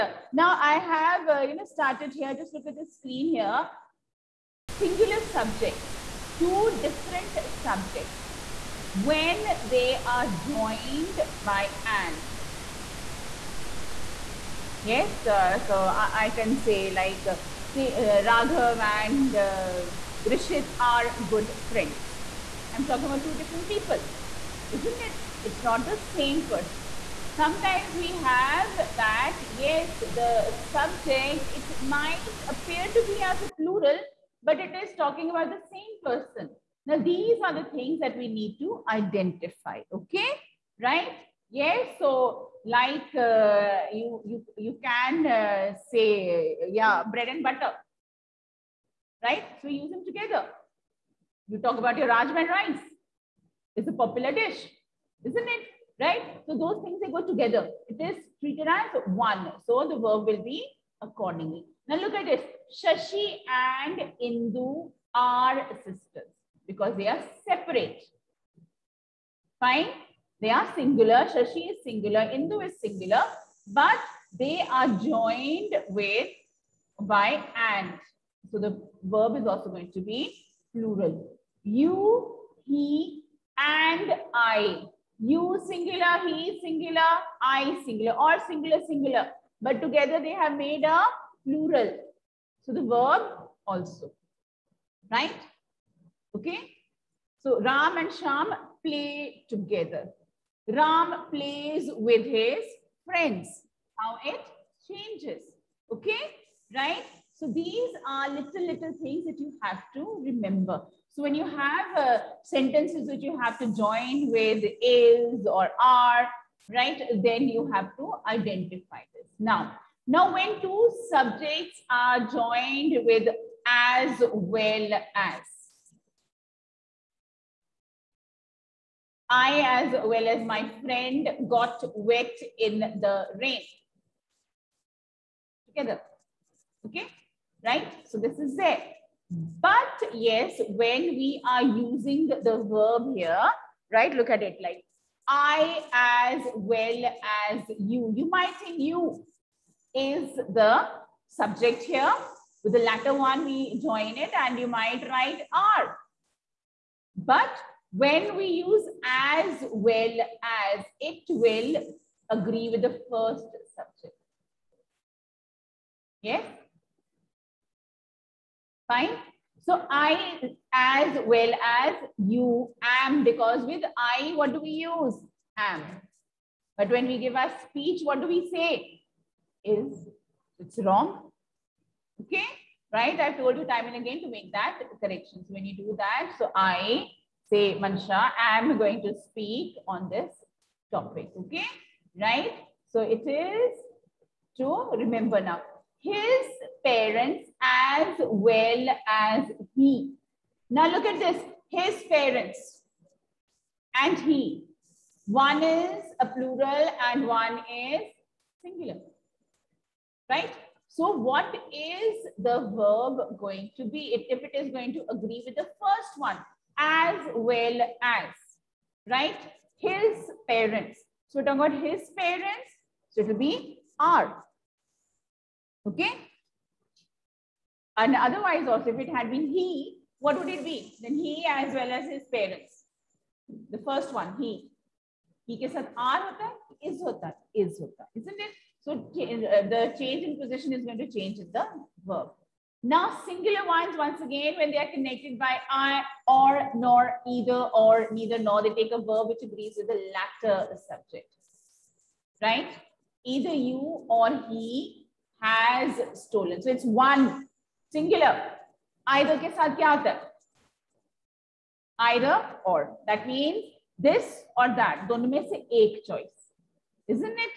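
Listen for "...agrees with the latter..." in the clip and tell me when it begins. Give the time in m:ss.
4:09.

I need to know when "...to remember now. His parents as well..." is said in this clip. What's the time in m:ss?
3:14.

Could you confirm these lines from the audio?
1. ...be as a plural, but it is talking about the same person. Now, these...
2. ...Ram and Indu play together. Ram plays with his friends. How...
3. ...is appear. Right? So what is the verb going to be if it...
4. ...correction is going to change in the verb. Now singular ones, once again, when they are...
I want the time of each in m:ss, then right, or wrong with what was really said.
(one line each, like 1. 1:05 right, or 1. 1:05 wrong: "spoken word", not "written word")
1. 0:33 right
2. 1:37 wrong: "Sham", not "Indu"
3. 3:27 wrong: "singular", not "appear"
4. 4:00 wrong: "position", not "correction".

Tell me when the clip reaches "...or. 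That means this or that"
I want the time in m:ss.
4:22.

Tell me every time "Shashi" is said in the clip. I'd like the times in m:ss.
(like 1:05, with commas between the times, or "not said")
1:02, 1:11.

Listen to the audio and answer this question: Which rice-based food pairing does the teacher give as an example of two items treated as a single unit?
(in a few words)
Rajma rice.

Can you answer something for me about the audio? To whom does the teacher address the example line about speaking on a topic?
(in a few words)
Mansha.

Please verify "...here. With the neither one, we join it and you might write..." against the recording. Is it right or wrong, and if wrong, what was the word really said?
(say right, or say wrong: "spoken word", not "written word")
wrong: "latter", not "neither".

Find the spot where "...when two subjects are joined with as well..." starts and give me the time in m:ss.
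2:00.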